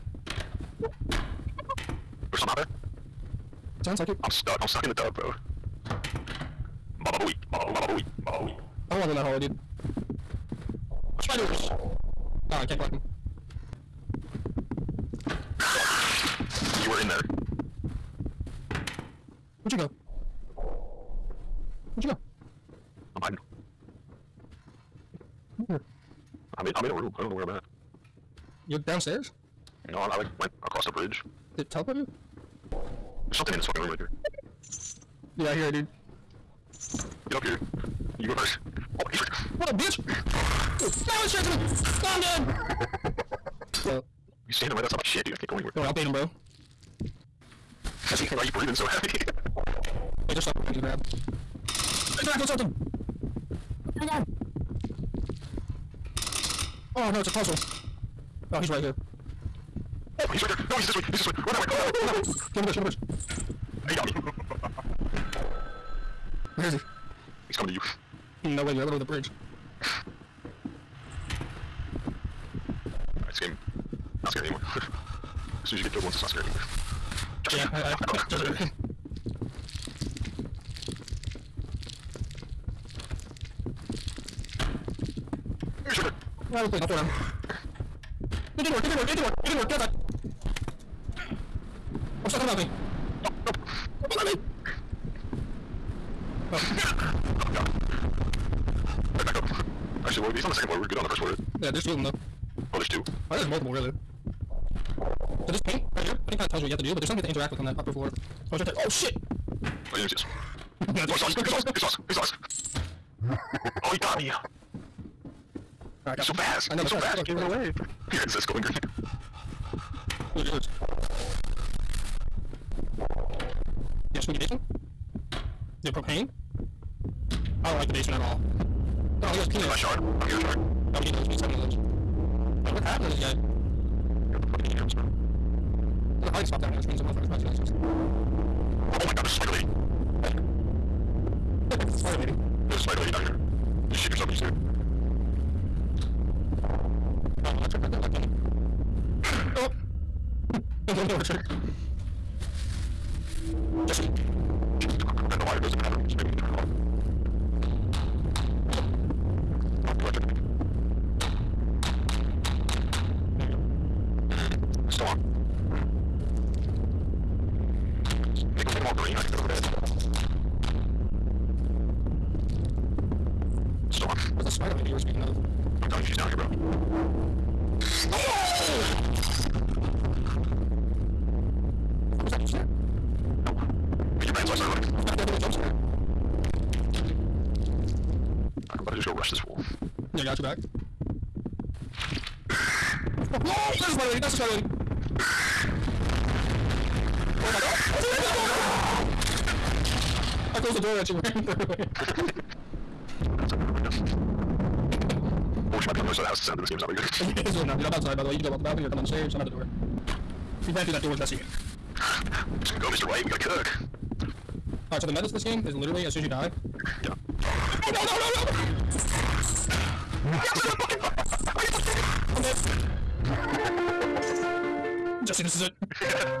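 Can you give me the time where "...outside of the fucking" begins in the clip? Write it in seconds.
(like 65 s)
220 s.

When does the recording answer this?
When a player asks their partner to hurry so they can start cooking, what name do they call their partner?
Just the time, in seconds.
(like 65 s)
212 s.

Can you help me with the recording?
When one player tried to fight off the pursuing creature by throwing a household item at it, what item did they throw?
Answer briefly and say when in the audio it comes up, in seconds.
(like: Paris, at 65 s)
A plate, at 86 s.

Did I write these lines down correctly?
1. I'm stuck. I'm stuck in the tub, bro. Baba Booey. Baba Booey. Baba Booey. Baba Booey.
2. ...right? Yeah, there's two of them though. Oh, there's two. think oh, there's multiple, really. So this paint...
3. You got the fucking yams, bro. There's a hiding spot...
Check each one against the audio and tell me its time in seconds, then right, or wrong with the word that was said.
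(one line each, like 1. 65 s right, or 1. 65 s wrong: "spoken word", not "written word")
1. 4 s right
2. 101 s right
3. 133 s right.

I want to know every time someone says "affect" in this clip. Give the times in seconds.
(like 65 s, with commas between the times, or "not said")
not said.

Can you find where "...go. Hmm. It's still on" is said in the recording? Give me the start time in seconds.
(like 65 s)
163 s.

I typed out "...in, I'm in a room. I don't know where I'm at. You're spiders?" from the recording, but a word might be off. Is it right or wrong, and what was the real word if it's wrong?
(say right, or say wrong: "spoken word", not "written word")
wrong: "downstairs", not "spiders".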